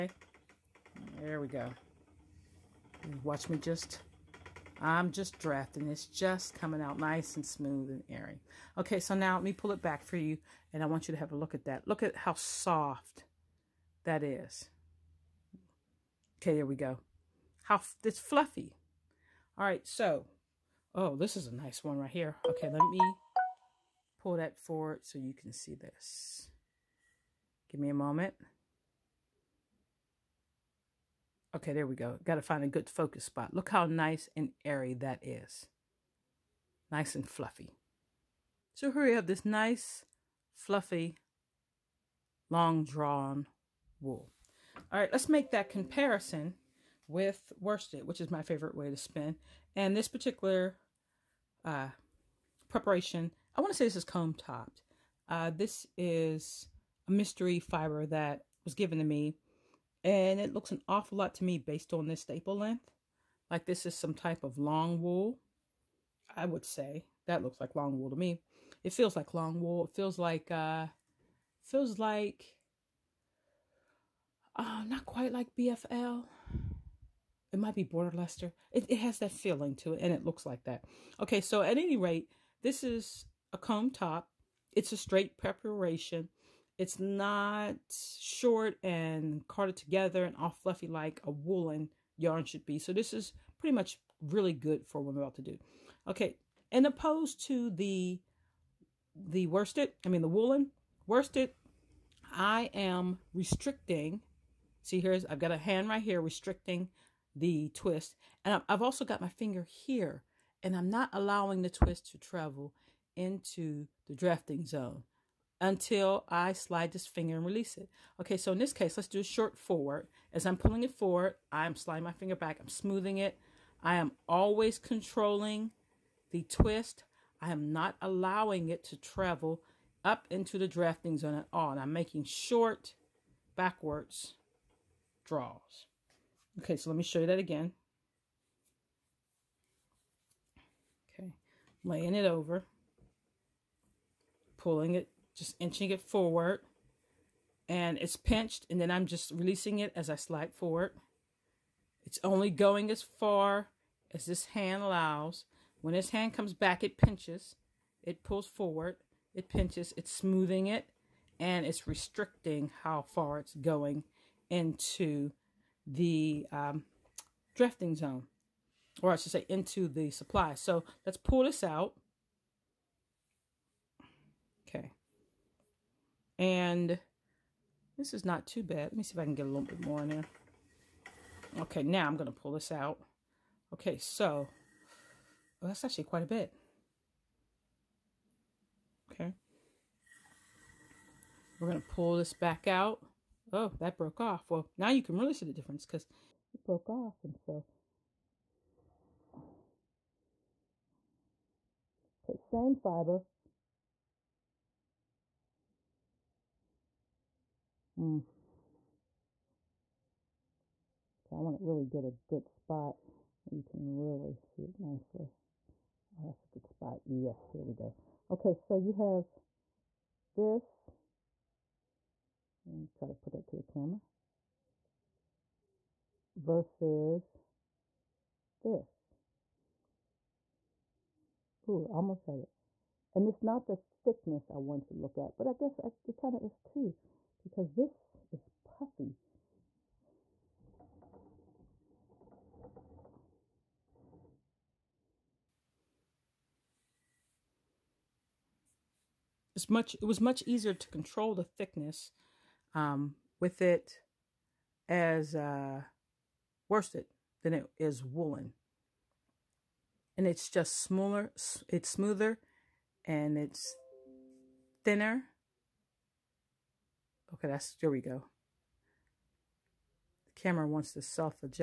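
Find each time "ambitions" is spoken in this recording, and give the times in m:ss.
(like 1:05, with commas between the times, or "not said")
not said.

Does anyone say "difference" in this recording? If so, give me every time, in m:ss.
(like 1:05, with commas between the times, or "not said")
3:15.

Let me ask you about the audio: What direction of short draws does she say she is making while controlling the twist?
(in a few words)
Backwards.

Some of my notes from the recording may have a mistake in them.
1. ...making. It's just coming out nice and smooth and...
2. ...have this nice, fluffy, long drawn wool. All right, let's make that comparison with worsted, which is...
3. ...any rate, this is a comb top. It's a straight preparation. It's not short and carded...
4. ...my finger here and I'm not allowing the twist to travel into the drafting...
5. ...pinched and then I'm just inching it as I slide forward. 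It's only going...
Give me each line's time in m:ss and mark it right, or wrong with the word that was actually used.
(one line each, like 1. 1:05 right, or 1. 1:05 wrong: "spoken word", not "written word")
1. 0:05 wrong: "drafting", not "making"
2. 0:39 right
3. 1:21 right
4. 1:49 right
5. 2:28 wrong: "releasing", not "inching".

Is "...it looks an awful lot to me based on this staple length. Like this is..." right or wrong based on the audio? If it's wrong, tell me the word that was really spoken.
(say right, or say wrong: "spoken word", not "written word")
right.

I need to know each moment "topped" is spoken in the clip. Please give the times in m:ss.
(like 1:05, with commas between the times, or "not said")
0:54.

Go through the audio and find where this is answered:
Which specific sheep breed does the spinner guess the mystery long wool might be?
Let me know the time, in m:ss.
1:17.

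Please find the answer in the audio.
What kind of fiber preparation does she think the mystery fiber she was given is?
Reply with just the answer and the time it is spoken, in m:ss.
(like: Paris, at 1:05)
Comb top, at 0:54.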